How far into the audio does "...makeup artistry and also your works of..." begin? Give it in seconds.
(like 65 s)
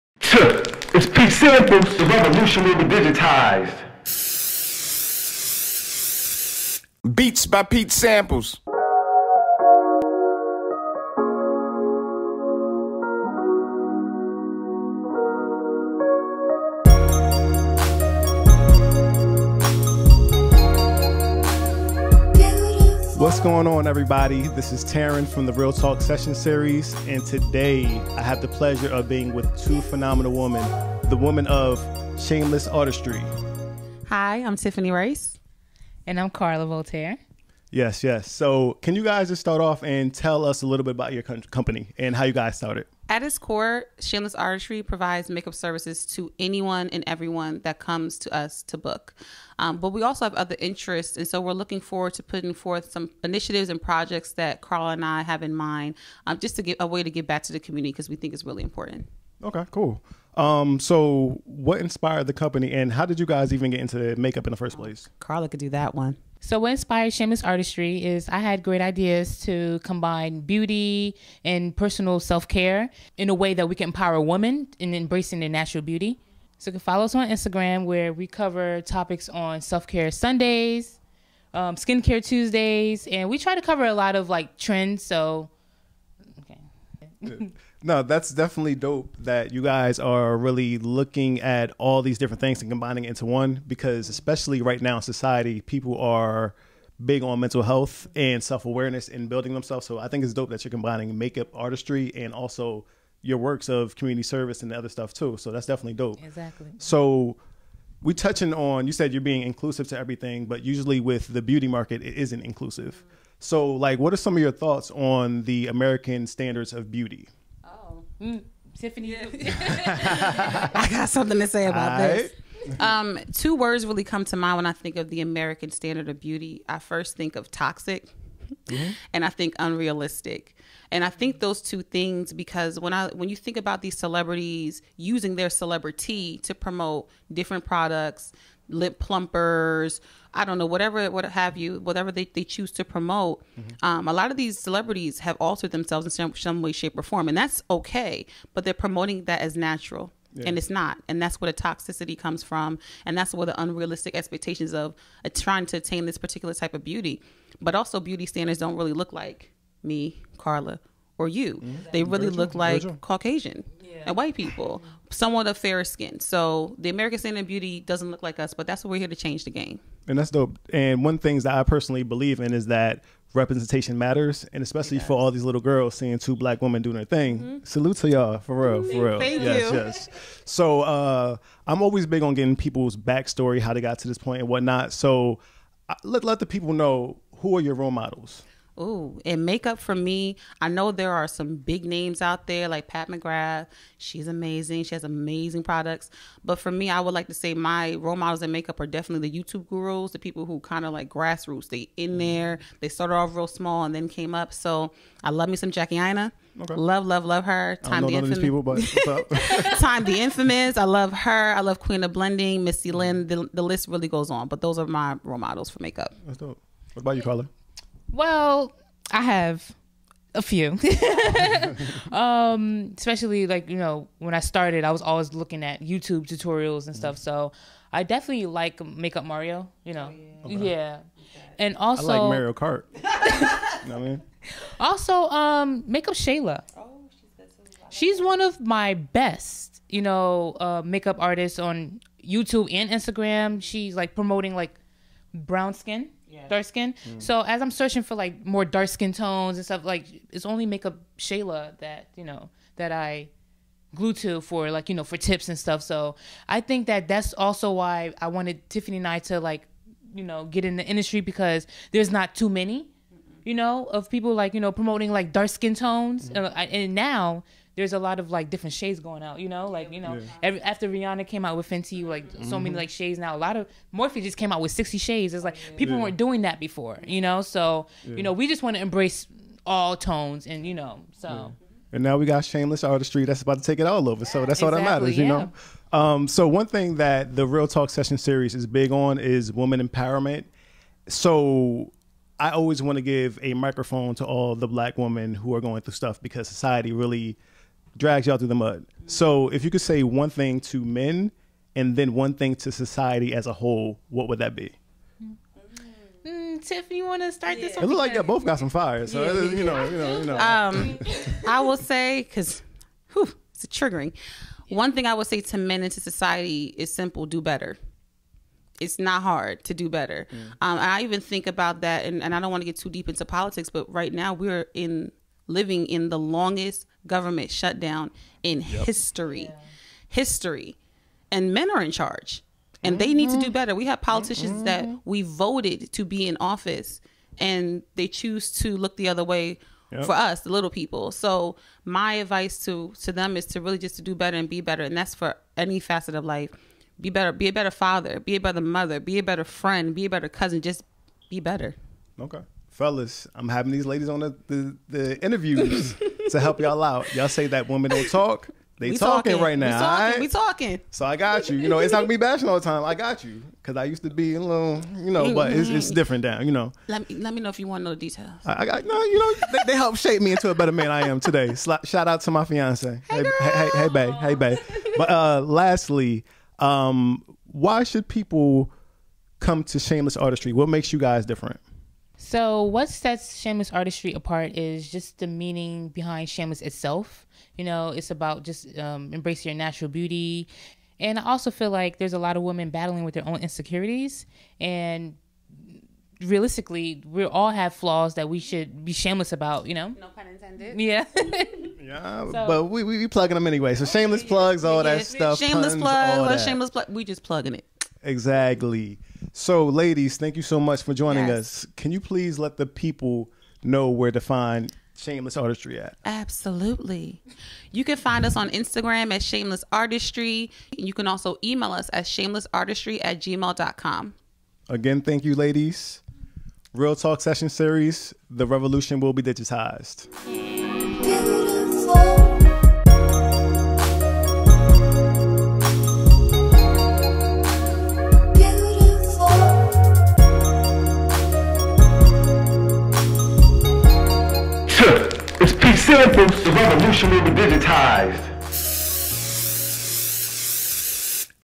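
101 s.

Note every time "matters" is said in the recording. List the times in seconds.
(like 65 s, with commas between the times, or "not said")
173 s, 285 s.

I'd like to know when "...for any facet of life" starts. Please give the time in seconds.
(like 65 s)
345 s.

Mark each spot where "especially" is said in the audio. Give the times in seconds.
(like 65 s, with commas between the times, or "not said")
94 s, 174 s, 222 s.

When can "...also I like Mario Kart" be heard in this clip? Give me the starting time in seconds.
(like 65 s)
231 s.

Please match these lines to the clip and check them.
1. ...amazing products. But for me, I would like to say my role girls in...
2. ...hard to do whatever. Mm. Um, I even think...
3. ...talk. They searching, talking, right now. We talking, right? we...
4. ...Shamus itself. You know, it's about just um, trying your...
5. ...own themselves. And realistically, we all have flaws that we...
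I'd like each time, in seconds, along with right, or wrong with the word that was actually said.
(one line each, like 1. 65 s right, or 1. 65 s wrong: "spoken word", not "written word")
1. 195 s wrong: "models", not "girls"
2. 319 s wrong: "better", not "whatever"
3. 358 s wrong: "talking", not "searching"
4. 386 s wrong: "embracing", not "trying"
5. 393 s wrong: "insecurities", not "themselves".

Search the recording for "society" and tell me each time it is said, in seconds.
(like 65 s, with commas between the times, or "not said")
95 s, 296 s, 302 s, 315 s.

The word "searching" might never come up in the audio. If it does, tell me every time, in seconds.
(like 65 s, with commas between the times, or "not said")
247 s.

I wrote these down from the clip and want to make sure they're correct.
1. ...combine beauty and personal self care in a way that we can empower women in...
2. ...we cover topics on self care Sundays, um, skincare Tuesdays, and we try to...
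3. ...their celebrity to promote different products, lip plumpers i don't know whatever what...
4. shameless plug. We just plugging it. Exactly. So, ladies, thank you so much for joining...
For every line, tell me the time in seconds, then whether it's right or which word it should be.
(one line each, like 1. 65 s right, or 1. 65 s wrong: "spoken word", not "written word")
1. 69 s right
2. 78 s right
3. 135 s right
4. 406 s right.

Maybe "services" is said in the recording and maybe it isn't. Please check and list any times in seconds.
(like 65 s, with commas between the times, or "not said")
45 s, 104 s.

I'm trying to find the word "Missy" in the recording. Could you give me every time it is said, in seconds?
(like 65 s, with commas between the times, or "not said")
212 s.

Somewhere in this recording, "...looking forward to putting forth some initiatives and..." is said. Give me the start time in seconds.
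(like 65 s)
51 s.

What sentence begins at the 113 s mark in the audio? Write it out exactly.
So like what are some of your thoughts on the American standards of beauty?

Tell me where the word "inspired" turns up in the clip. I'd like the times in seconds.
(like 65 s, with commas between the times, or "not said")
61 s, 66 s.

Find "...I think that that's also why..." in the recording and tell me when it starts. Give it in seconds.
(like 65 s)
256 s.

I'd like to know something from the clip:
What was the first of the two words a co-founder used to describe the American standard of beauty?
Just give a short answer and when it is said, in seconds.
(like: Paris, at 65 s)
Toxic, at 127 s.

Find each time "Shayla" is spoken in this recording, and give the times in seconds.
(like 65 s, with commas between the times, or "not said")
236 s, 251 s.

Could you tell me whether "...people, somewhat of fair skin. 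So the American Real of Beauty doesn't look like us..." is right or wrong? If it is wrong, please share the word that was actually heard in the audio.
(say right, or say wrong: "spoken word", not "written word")
wrong: "Standard", not "Real".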